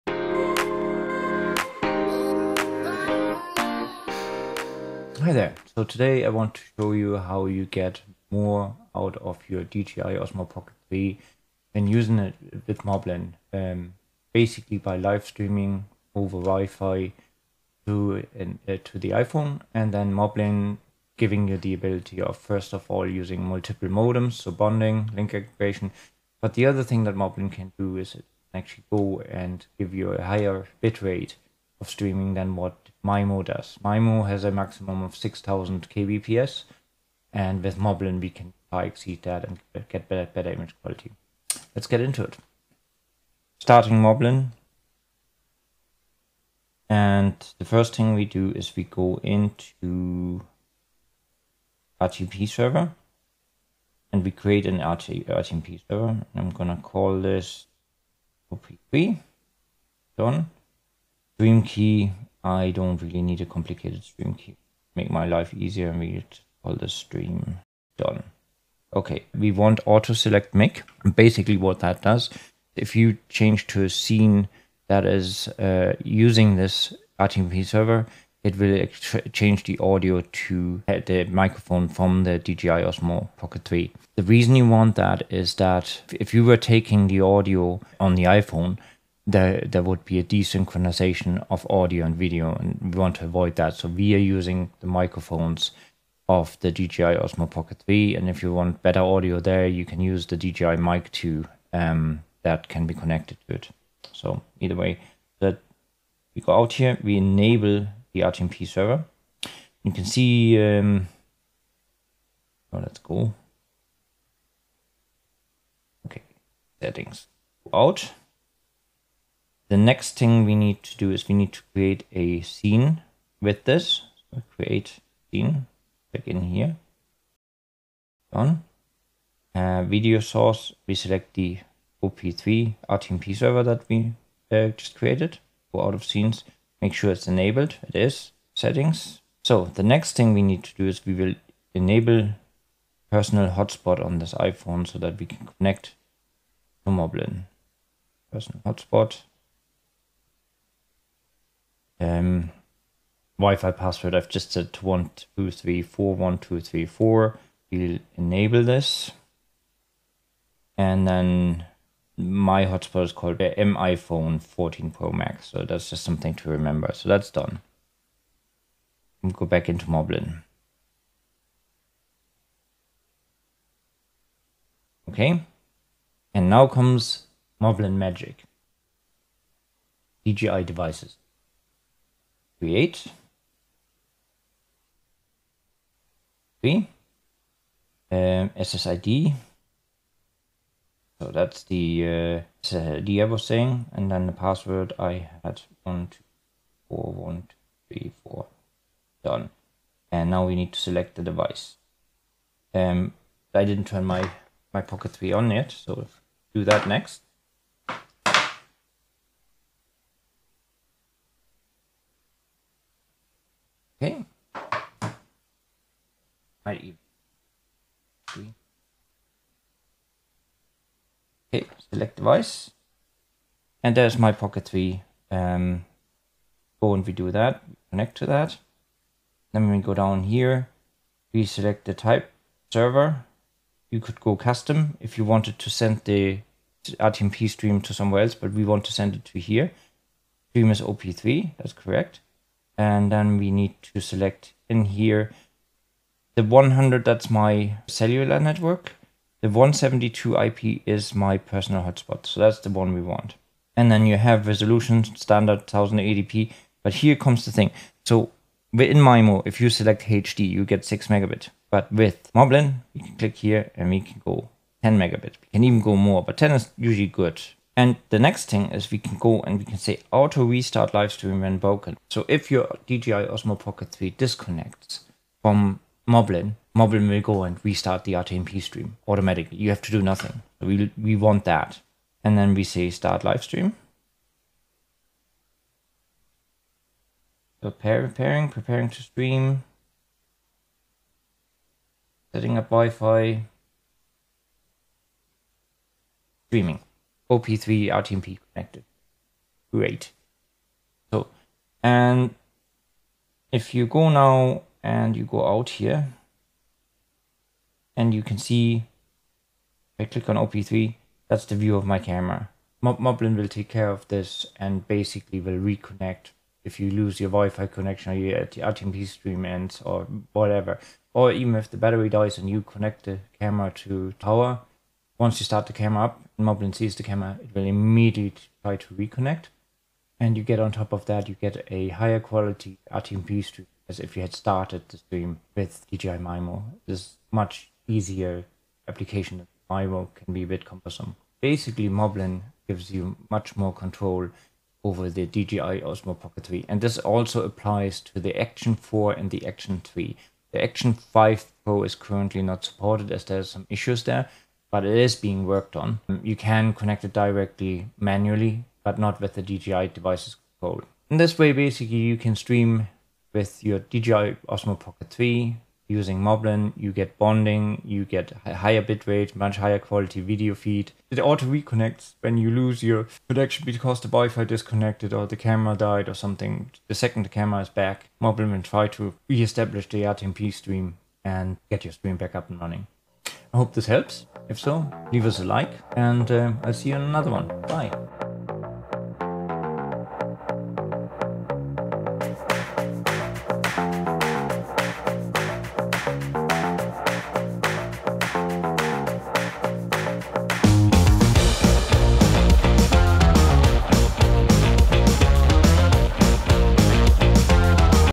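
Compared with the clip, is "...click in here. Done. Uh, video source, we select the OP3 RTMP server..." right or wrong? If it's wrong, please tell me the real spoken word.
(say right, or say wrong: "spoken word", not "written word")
right.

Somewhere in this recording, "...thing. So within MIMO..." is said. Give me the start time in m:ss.
4:17.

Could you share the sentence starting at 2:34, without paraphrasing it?
I've just said one two three four one two three four.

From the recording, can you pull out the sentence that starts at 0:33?
MIMO has a maximum of 6000 kbps, and with Moblin we can exceed that and get better, better image quality.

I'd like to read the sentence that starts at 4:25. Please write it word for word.
We can even go more, but 10 is usually good.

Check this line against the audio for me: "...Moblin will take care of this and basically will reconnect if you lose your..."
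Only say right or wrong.
right.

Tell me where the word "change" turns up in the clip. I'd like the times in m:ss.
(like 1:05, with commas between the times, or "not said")
1:13, 1:19.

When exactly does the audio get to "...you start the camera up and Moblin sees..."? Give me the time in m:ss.
5:25.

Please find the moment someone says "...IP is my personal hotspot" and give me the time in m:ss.
4:10.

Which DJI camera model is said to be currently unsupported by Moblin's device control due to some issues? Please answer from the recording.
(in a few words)
Action 5 Pro.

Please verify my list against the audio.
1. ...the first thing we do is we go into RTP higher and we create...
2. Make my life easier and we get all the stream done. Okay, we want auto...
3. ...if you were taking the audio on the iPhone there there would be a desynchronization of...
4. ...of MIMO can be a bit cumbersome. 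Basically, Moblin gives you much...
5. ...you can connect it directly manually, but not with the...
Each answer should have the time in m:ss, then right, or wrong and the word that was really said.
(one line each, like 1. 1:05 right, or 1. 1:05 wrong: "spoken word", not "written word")
1. 0:47 wrong: "server", not "higher"
2. 1:04 right
3. 1:26 right
4. 5:39 right
5. 5:56 right.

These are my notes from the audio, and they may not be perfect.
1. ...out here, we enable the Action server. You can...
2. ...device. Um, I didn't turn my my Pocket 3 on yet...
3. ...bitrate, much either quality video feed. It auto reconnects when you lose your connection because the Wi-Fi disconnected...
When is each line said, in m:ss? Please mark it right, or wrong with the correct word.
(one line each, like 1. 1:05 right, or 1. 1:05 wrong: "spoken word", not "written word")
1. 1:46 wrong: "RTMP", not "Action"
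2. 3:21 right
3. 6:08 wrong: "higher", not "either".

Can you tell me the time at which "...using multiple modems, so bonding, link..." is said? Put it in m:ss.
0:23.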